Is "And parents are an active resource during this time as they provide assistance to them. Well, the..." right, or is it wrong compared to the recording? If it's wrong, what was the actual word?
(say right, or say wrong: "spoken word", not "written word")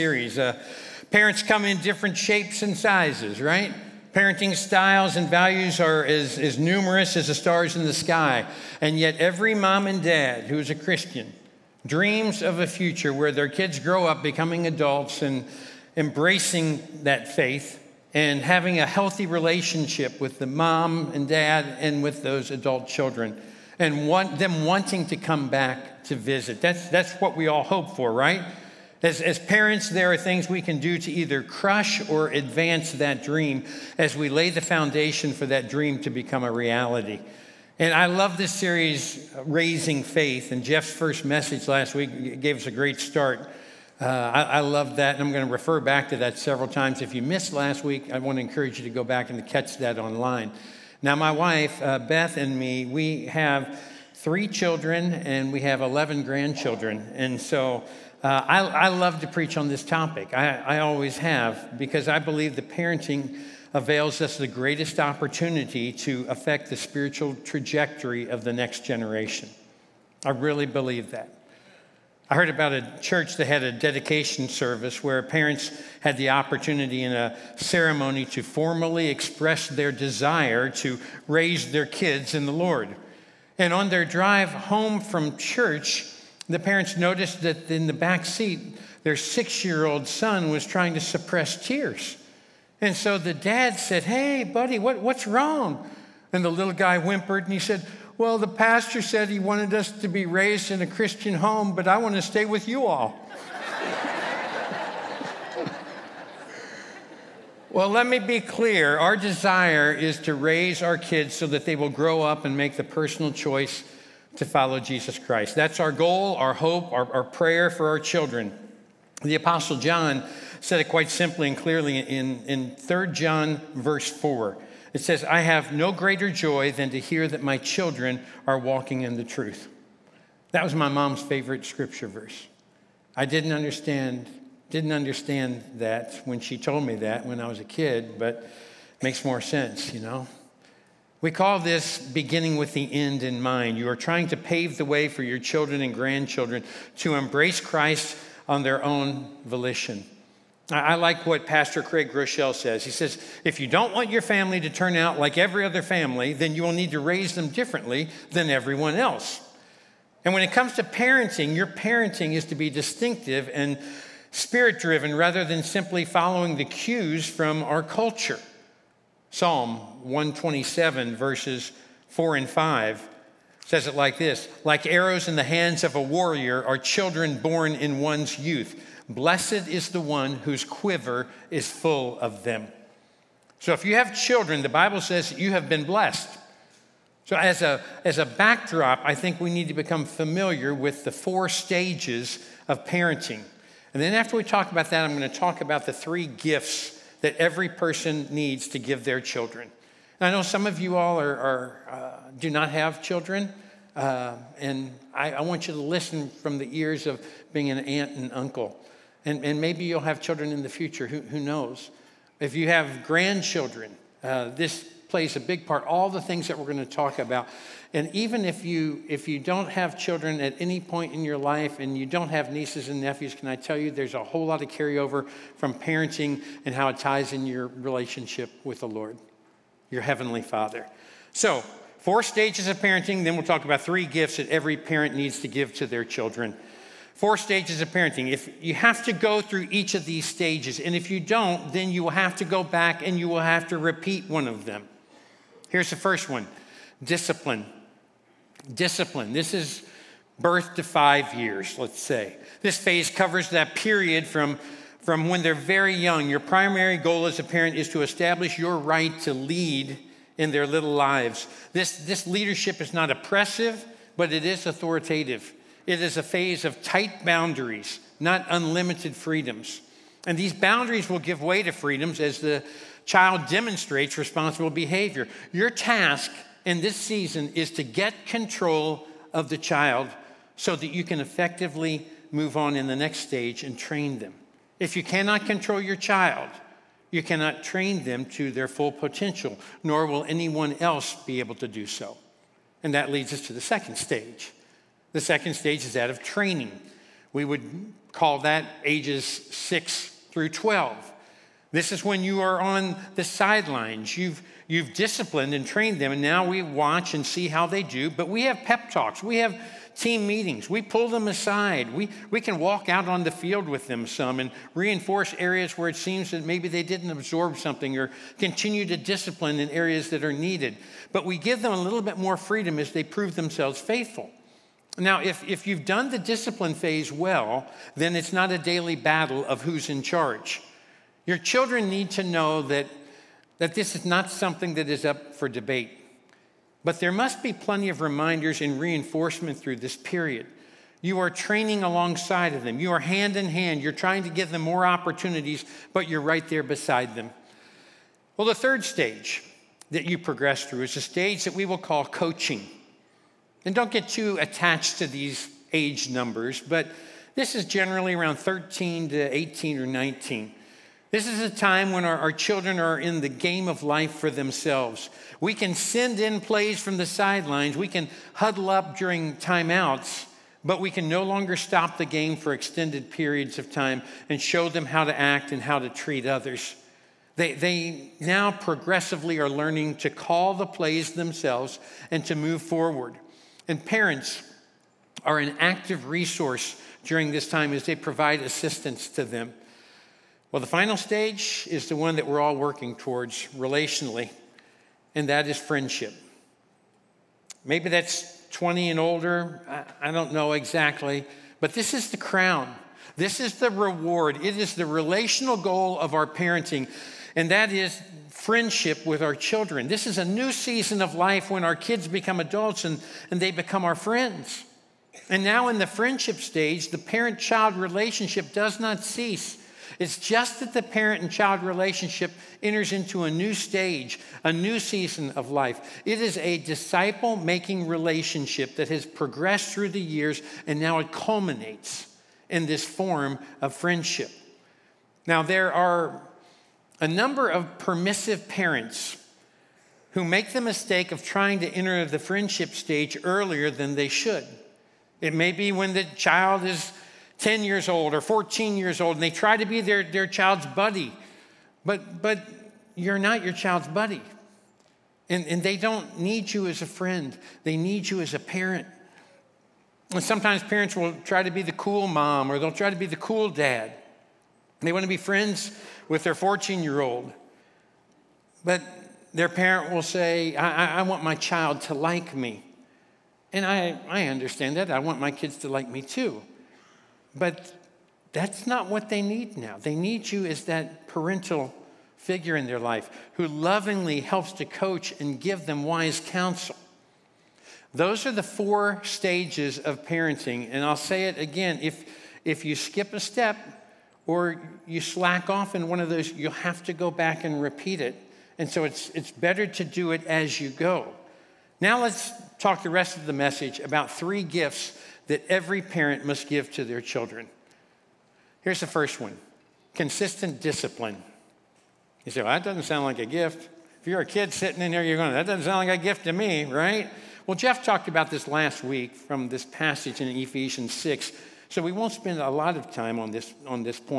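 right.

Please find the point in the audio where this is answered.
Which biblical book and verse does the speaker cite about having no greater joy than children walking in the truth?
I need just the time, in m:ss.
2:02.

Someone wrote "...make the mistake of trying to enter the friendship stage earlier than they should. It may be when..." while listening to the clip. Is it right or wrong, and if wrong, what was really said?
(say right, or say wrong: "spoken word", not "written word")
right.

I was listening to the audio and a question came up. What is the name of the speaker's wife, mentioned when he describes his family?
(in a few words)
Beth.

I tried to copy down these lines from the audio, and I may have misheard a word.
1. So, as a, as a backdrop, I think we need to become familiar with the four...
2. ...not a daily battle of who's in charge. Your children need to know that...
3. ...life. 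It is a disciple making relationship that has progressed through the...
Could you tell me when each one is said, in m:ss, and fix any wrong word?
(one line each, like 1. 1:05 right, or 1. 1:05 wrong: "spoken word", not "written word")
1. 3:07 right
2. 5:28 right
3. 7:05 right.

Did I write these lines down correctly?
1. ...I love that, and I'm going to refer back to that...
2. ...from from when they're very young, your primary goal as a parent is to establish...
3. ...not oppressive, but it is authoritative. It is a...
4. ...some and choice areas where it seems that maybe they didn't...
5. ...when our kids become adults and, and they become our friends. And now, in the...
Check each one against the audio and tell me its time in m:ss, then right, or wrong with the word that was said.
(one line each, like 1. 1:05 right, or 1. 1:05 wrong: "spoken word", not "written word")
1. 0:44 right
2. 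4:14 right
3. 4:22 right
4. 5:14 wrong: "reinforce", not "choice"
5. 6:51 right.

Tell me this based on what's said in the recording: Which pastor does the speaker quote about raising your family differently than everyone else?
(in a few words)
Craig Groeschel.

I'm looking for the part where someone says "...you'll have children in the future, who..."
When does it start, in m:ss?
3:29.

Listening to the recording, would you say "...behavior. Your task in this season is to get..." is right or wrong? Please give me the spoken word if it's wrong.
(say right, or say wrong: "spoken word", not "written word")
right.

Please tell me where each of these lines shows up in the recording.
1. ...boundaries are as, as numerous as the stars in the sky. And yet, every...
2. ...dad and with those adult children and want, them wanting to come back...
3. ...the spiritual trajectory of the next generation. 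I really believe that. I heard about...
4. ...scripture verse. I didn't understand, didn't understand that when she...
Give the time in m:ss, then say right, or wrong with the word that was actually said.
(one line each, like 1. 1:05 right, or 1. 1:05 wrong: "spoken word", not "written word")
1. 0:05 wrong: "values", not "boundaries"
2. 0:21 right
3. 1:06 right
4. 2:11 right.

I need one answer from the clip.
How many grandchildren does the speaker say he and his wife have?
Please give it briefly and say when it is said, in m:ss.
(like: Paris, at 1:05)
11, at 0:55.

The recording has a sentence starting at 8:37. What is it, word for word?
Well, Jeff talked about this last week from this passage in Ephesians 6.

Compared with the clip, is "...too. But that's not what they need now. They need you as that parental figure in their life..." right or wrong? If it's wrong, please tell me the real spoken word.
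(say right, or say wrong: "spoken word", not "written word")
right.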